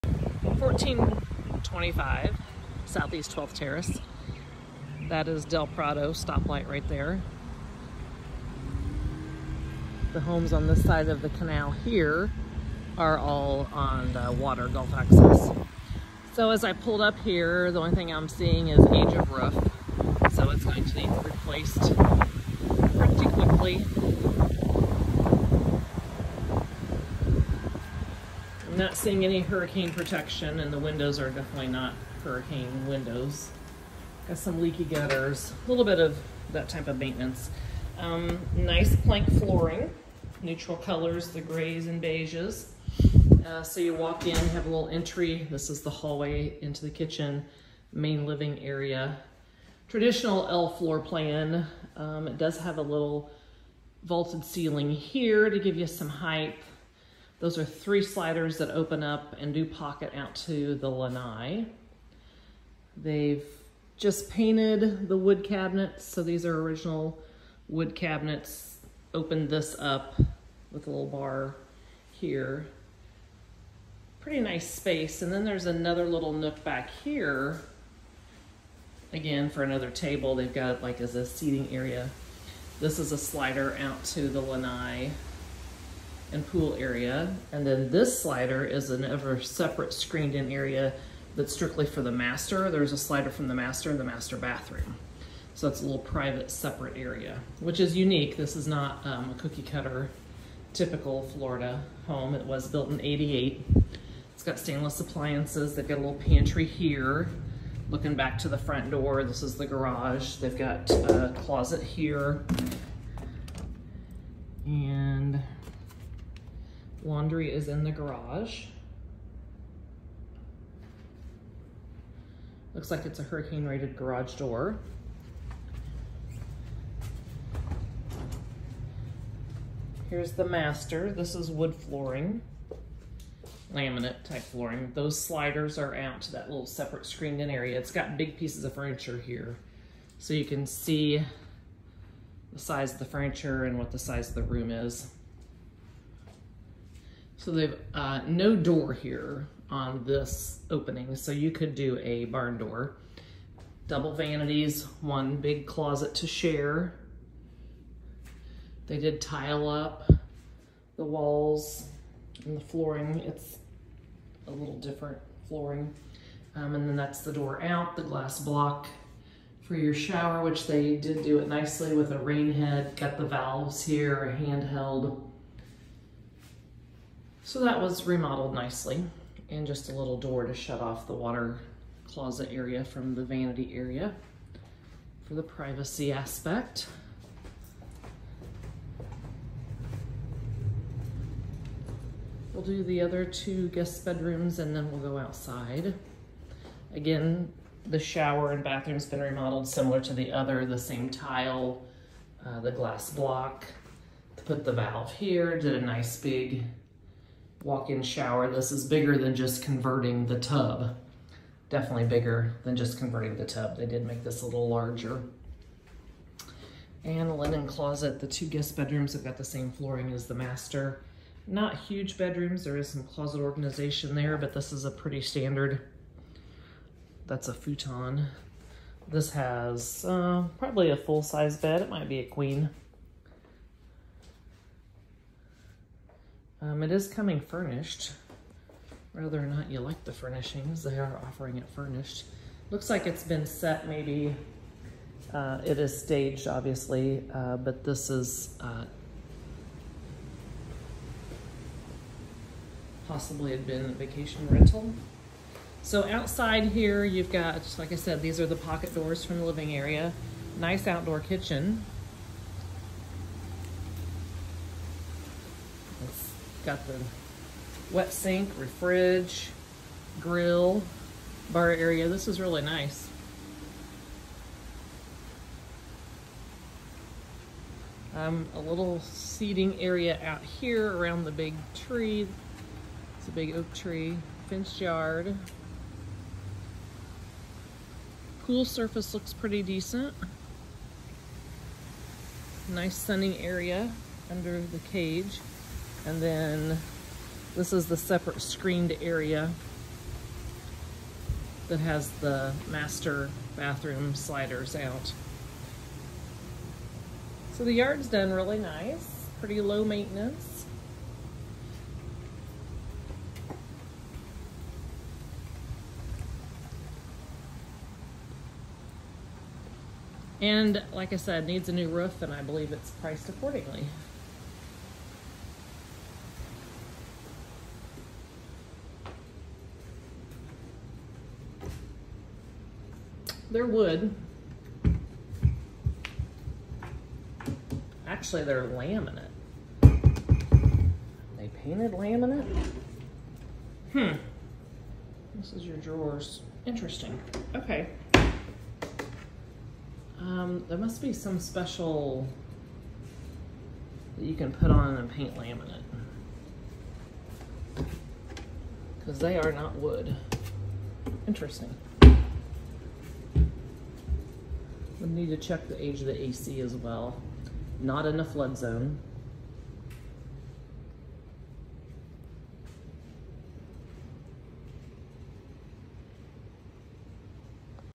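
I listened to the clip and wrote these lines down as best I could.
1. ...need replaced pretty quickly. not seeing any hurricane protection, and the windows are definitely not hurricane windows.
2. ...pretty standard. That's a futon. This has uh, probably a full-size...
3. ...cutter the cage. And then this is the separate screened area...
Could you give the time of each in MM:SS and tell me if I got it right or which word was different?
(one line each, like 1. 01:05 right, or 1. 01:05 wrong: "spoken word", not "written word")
1. 00:20 right
2. 03:44 right
3. 04:54 wrong: "under", not "cutter".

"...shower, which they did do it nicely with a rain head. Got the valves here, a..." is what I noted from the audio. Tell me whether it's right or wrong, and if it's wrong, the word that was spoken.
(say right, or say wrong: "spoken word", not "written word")
right.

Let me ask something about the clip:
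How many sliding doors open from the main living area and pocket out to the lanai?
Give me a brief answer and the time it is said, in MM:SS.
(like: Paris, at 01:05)
3, at 00:57.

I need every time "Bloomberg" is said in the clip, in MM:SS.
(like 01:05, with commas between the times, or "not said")
not said.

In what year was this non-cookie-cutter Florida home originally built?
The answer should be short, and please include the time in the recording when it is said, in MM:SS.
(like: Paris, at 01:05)
1988, at 01:43.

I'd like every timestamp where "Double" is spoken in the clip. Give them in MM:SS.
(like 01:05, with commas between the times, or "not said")
02:33.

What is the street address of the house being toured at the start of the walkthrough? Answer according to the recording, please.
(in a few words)
1425 Southeast 12th Terrace.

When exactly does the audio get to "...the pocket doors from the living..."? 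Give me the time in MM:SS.
04:18.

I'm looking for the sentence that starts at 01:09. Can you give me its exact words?
Opened this up with a little bar here.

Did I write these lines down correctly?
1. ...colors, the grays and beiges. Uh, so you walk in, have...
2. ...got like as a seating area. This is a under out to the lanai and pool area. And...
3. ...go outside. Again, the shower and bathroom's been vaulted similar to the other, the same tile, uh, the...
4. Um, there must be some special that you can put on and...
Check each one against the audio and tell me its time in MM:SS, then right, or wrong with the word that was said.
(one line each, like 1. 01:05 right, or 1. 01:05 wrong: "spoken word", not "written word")
1. 00:40 right
2. 01:20 wrong: "slider", not "under"
3. 03:15 wrong: "remodeled", not "vaulted"
4. 05:50 right.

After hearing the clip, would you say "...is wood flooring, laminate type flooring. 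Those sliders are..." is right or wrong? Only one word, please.
right.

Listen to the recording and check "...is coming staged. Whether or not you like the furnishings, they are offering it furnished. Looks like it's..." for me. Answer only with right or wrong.
wrong.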